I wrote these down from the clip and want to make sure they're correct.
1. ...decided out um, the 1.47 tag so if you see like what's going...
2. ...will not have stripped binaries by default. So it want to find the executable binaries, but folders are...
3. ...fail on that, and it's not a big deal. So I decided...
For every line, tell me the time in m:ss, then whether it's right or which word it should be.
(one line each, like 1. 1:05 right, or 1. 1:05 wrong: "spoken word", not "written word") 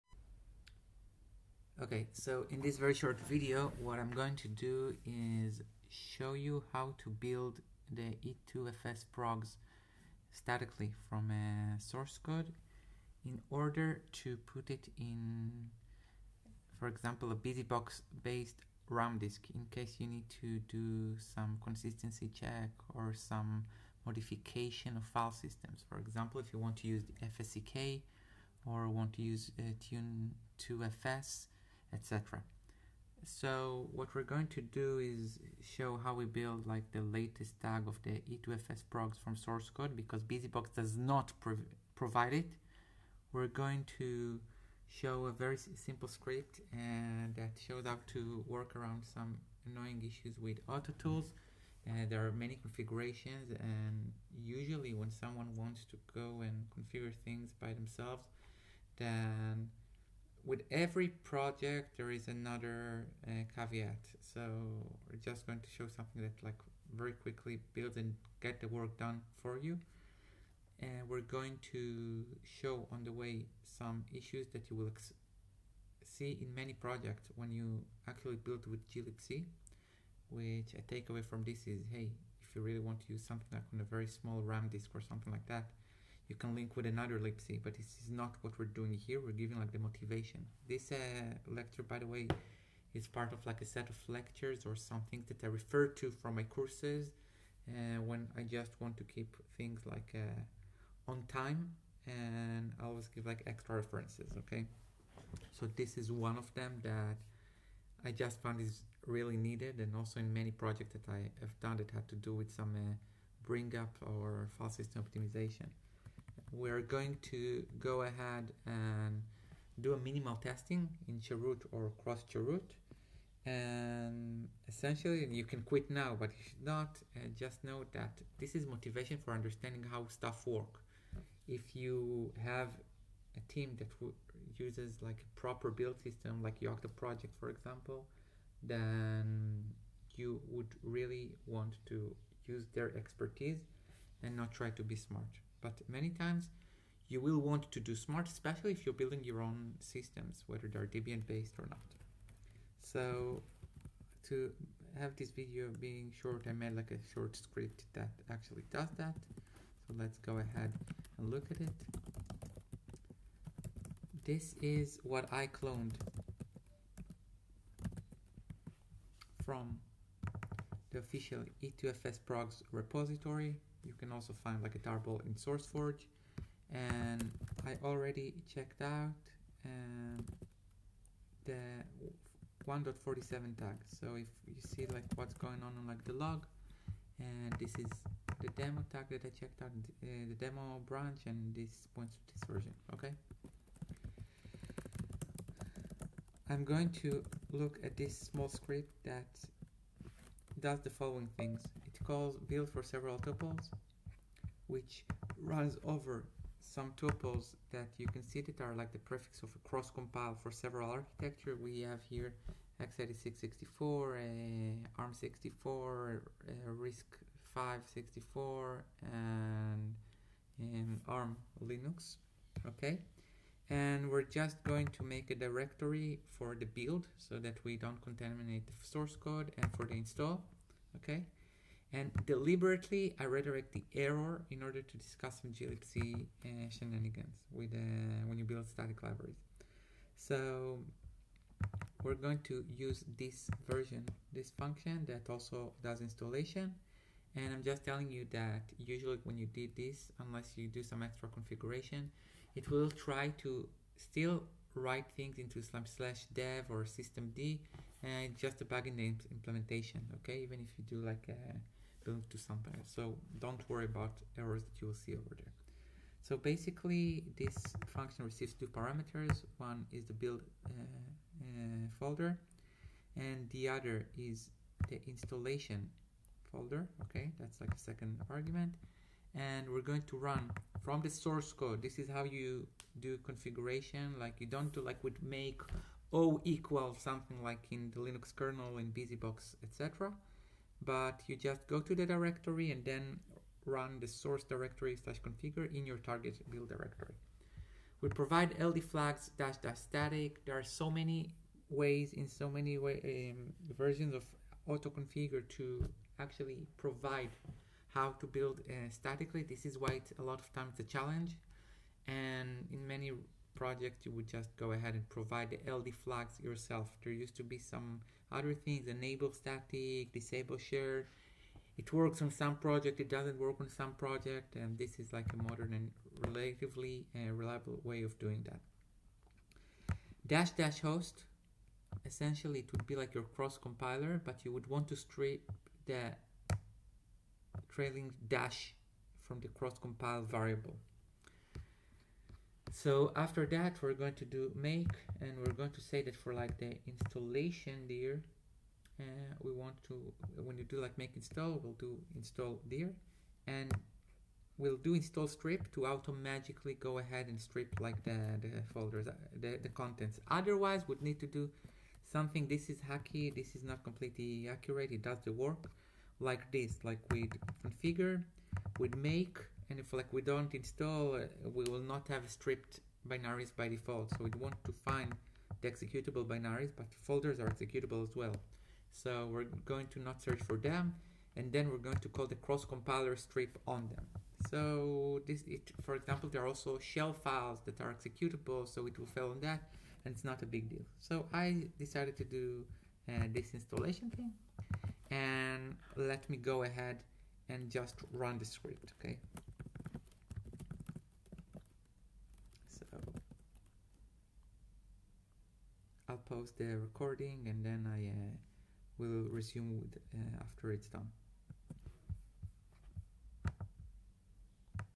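1. 2:58 wrong: "checked", not "decided"
2. 6:11 right
3. 6:29 right.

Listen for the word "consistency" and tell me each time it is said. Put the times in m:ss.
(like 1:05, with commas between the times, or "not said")
0:21.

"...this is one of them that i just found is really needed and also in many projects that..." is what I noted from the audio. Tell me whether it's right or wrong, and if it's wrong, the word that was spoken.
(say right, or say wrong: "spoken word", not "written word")
right.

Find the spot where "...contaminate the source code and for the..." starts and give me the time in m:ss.
3:48.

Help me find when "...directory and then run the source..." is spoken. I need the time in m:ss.
4:52.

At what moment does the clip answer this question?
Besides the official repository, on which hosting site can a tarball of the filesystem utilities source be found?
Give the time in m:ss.
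2:55.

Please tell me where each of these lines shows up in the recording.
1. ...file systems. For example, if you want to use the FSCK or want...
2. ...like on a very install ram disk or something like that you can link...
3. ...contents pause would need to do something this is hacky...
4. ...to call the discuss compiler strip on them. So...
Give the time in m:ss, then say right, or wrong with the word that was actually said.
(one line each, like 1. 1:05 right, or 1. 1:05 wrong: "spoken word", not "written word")
1. 0:25 right
2. 1:23 wrong: "small", not "install"
3. 5:59 wrong: "otherwise", not "pause"
4. 6:22 wrong: "cross", not "discuss".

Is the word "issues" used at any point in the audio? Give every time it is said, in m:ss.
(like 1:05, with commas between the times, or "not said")
0:50, 1:14.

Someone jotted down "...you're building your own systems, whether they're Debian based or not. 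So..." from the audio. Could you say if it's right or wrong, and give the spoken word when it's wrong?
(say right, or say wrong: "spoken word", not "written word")
right.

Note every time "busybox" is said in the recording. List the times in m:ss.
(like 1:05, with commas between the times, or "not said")
0:17, 0:40, 4:48.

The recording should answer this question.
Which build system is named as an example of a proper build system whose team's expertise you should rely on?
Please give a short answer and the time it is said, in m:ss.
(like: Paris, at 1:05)
Yocto project, at 2:16.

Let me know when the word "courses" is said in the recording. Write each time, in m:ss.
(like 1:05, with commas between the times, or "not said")
1:36.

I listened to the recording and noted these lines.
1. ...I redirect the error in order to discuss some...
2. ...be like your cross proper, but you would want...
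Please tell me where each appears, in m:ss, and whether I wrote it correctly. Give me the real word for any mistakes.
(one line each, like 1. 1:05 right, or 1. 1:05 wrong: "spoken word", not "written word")
1. 3:53 right
2. 5:32 wrong: "compiler", not "proper".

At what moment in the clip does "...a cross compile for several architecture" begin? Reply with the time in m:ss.
3:29.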